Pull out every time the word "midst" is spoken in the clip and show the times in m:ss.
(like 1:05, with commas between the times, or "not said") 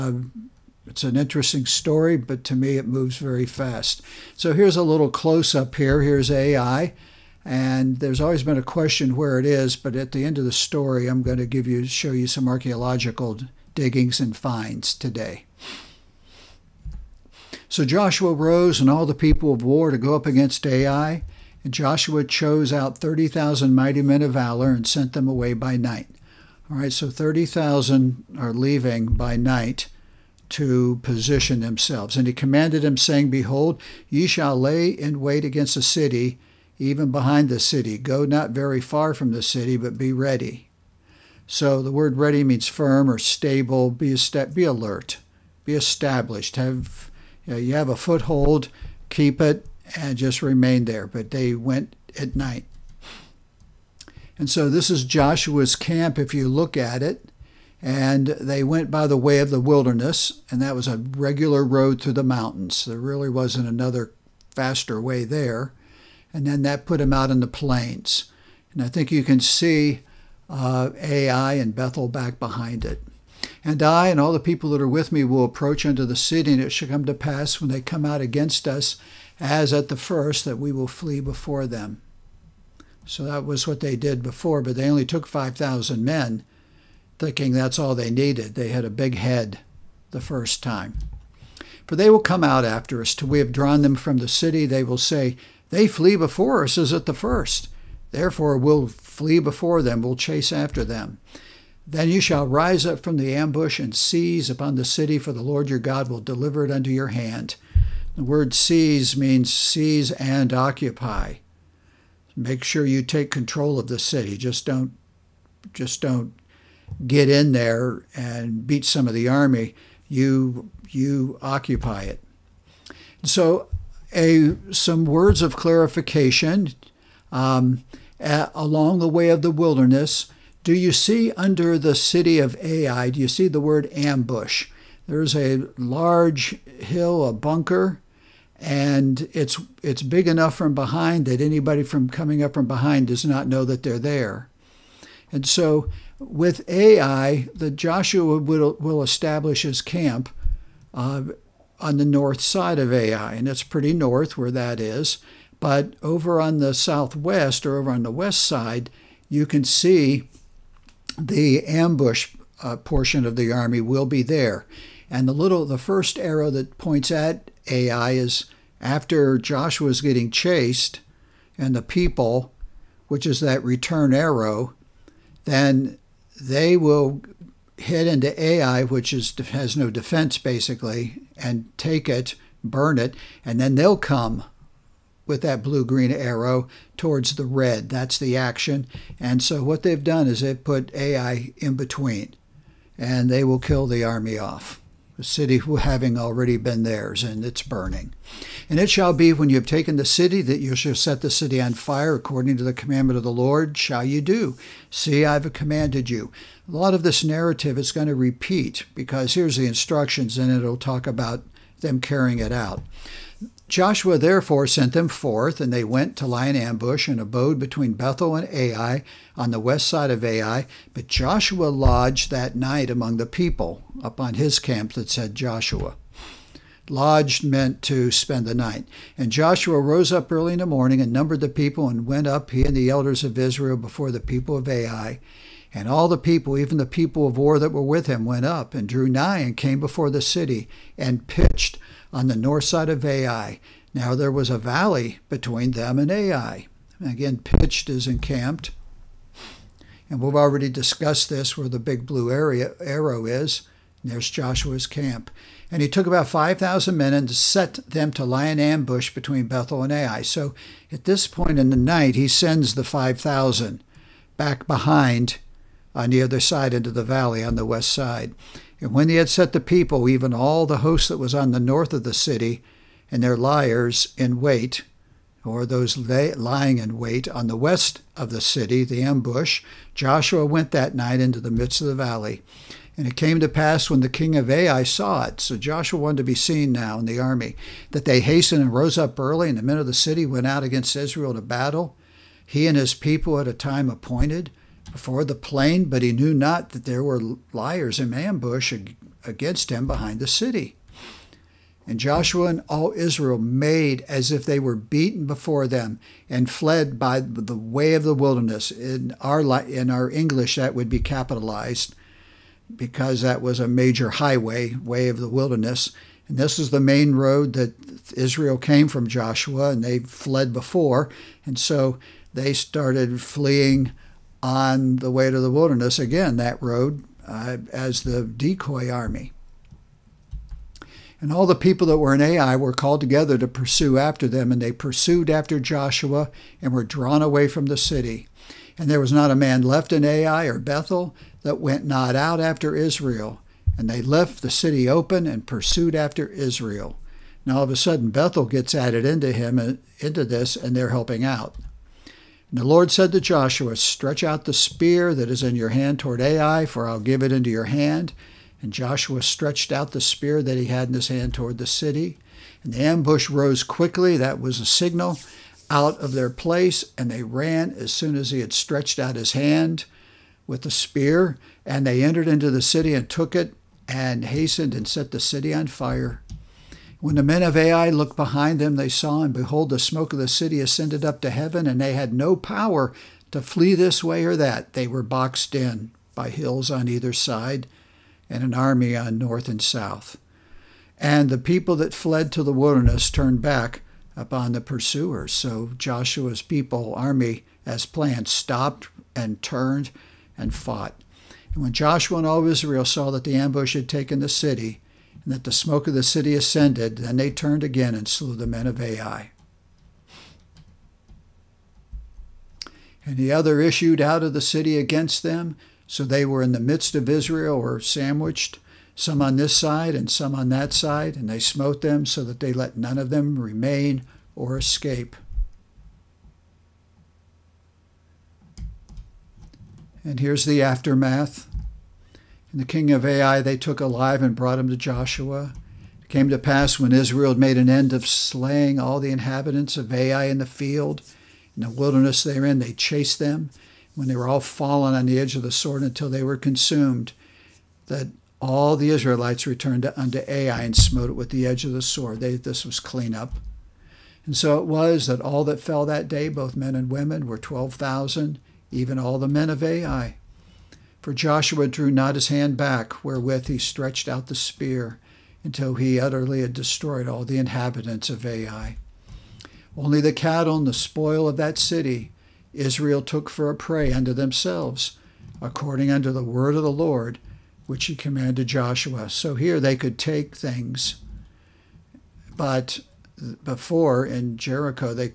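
4:41, 6:56.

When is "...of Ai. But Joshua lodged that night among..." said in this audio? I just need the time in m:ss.
3:40.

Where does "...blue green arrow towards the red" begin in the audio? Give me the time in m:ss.
3:05.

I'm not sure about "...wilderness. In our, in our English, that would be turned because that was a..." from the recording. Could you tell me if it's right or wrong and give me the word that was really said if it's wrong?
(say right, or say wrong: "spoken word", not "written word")
wrong: "capitalized", not "turned".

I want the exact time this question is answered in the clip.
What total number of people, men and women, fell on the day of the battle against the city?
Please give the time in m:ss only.
7:37.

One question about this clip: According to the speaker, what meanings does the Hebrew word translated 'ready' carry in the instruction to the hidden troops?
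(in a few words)
firm or stable.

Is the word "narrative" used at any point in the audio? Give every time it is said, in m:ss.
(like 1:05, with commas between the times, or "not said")
3:27.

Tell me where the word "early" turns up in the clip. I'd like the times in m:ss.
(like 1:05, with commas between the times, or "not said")
3:50, 4:49.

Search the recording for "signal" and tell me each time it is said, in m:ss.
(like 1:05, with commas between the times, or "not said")
6:04.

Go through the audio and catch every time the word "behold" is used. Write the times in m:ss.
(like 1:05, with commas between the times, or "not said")
0:33, 6:19.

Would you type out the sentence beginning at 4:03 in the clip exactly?
Now there was a valley between them and Ai.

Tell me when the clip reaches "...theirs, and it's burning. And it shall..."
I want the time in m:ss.
3:16.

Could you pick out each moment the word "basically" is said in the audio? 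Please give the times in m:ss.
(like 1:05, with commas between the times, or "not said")
3:00.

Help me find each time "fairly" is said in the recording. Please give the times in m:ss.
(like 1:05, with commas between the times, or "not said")
not said.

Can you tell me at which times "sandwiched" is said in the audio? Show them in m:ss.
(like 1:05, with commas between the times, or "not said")
6:57.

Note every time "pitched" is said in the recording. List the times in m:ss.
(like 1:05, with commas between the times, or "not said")
4:01, 4:07.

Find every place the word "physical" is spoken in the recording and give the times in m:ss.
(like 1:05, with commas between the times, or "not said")
not said.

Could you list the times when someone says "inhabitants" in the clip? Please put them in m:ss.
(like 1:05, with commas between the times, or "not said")
7:19, 7:47.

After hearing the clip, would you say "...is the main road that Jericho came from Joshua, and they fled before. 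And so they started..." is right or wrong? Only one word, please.
wrong.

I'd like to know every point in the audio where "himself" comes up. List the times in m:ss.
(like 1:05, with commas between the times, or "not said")
not said.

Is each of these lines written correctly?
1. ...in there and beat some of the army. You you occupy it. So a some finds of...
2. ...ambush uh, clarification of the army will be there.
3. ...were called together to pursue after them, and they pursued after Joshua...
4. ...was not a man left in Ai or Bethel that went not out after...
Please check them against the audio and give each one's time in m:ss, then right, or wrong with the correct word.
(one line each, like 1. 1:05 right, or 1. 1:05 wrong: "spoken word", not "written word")
1. 1:57 wrong: "words", not "finds"
2. 2:41 wrong: "portion", not "clarification"
3. 5:32 right
4. 5:38 right.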